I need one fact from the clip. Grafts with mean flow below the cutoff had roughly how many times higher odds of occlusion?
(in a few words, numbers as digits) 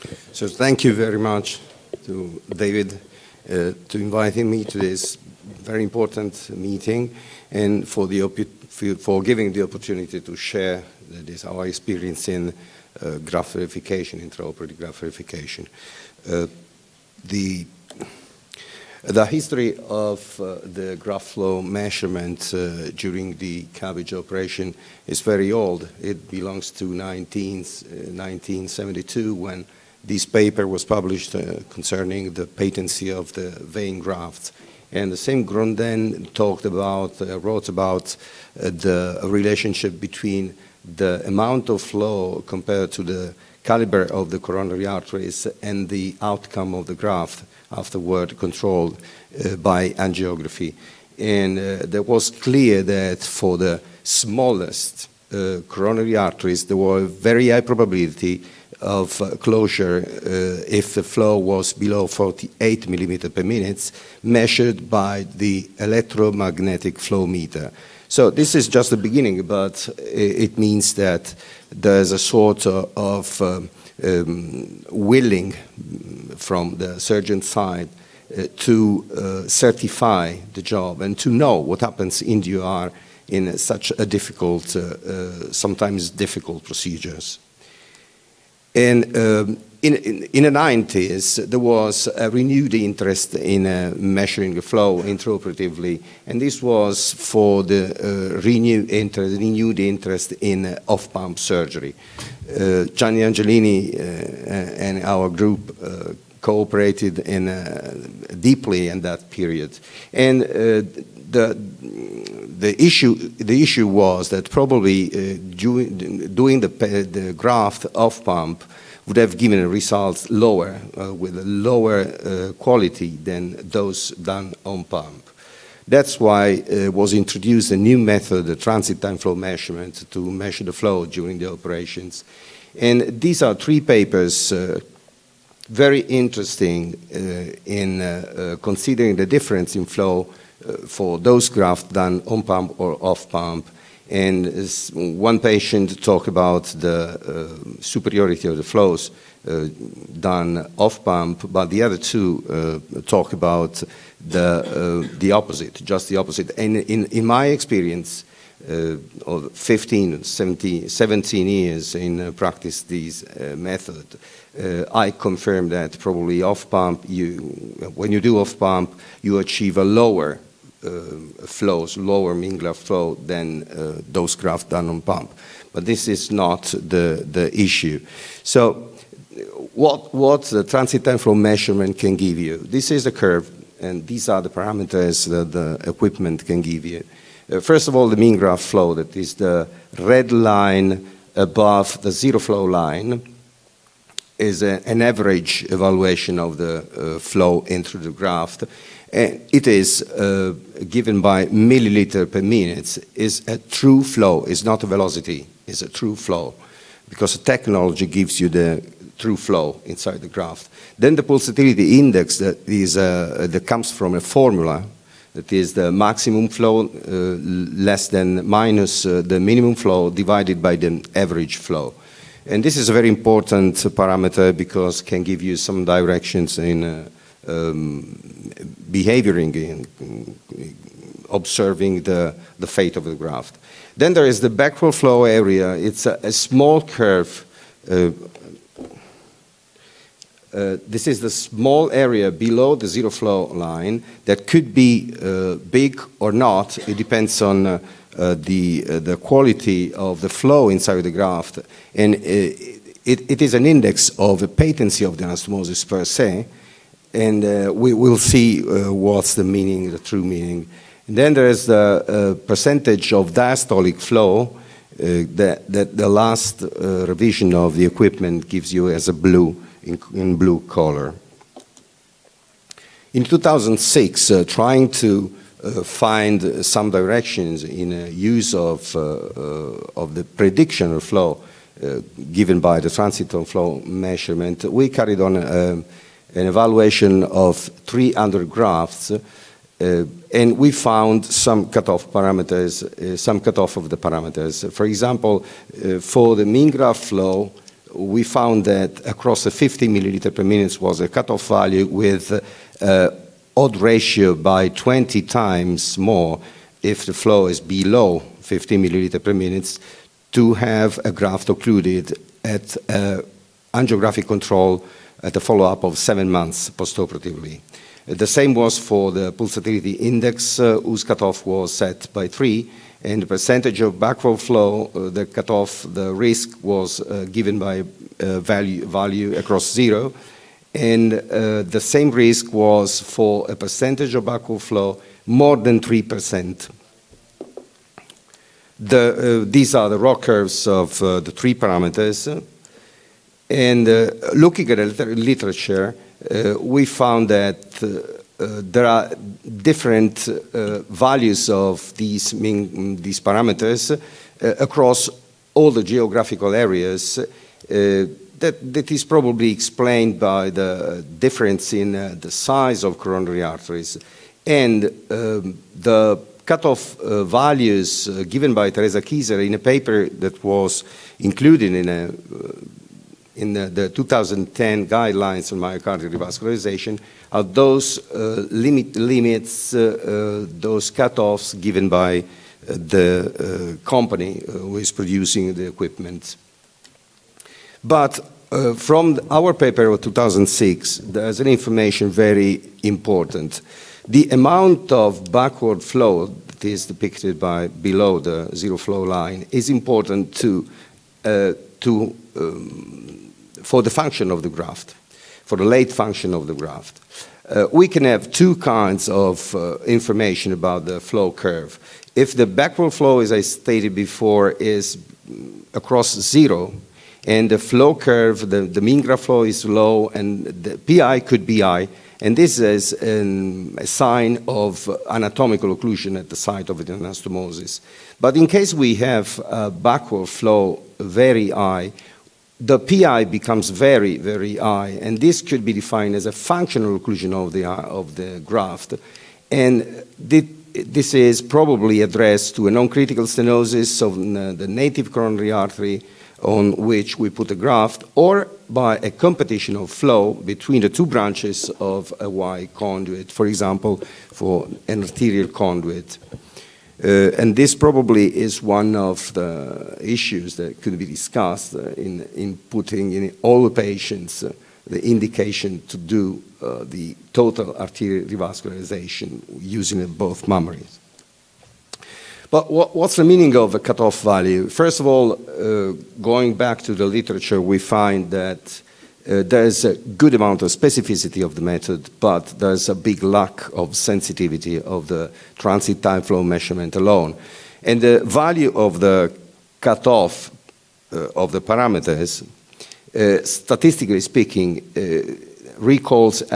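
20.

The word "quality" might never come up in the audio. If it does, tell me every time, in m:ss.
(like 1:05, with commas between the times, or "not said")
2:02, 4:09.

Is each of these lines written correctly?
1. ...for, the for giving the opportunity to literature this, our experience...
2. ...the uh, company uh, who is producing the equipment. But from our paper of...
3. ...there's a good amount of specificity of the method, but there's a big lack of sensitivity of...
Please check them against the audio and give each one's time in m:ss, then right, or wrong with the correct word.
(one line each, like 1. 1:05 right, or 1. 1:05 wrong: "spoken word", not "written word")
1. 0:07 wrong: "share", not "literature"
2. 6:22 right
3. 7:59 right.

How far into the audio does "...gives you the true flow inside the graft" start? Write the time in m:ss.
3:28.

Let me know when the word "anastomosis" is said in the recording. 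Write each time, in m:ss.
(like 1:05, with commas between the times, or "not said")
4:15, 7:06.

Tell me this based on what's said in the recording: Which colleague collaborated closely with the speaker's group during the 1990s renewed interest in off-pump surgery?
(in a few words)
Gianni Angelini.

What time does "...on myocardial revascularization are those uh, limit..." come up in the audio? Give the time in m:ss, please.
6:15.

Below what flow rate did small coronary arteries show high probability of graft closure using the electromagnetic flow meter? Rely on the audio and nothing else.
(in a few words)
48 millimeter per minute.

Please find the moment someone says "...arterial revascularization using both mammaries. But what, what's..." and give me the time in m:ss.
7:47.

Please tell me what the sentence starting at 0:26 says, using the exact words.
It belongs to 19, 1972 uh, when this paper was published uh, concerning the patency of the vein grafts.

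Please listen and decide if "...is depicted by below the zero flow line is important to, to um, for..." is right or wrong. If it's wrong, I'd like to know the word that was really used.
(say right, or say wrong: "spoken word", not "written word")
right.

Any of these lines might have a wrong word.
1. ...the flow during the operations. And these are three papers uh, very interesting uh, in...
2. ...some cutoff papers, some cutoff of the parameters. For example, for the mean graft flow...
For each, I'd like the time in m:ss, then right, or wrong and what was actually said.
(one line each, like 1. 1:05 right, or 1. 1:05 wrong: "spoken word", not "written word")
1. 2:10 right
2. 4:51 wrong: "parameters", not "papers".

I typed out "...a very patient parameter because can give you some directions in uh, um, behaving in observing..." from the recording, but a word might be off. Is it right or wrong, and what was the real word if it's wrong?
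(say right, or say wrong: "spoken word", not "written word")
wrong: "important", not "patient".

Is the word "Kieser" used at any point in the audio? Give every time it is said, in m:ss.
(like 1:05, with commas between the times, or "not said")
6:09.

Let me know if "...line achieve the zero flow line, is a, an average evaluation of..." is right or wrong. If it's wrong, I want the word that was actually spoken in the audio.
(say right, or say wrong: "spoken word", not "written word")
wrong: "above", not "achieve".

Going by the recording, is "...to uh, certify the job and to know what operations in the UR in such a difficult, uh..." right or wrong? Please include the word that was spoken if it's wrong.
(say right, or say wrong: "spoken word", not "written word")
wrong: "happens", not "operations".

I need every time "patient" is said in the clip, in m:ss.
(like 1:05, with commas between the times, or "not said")
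2:25, 7:43.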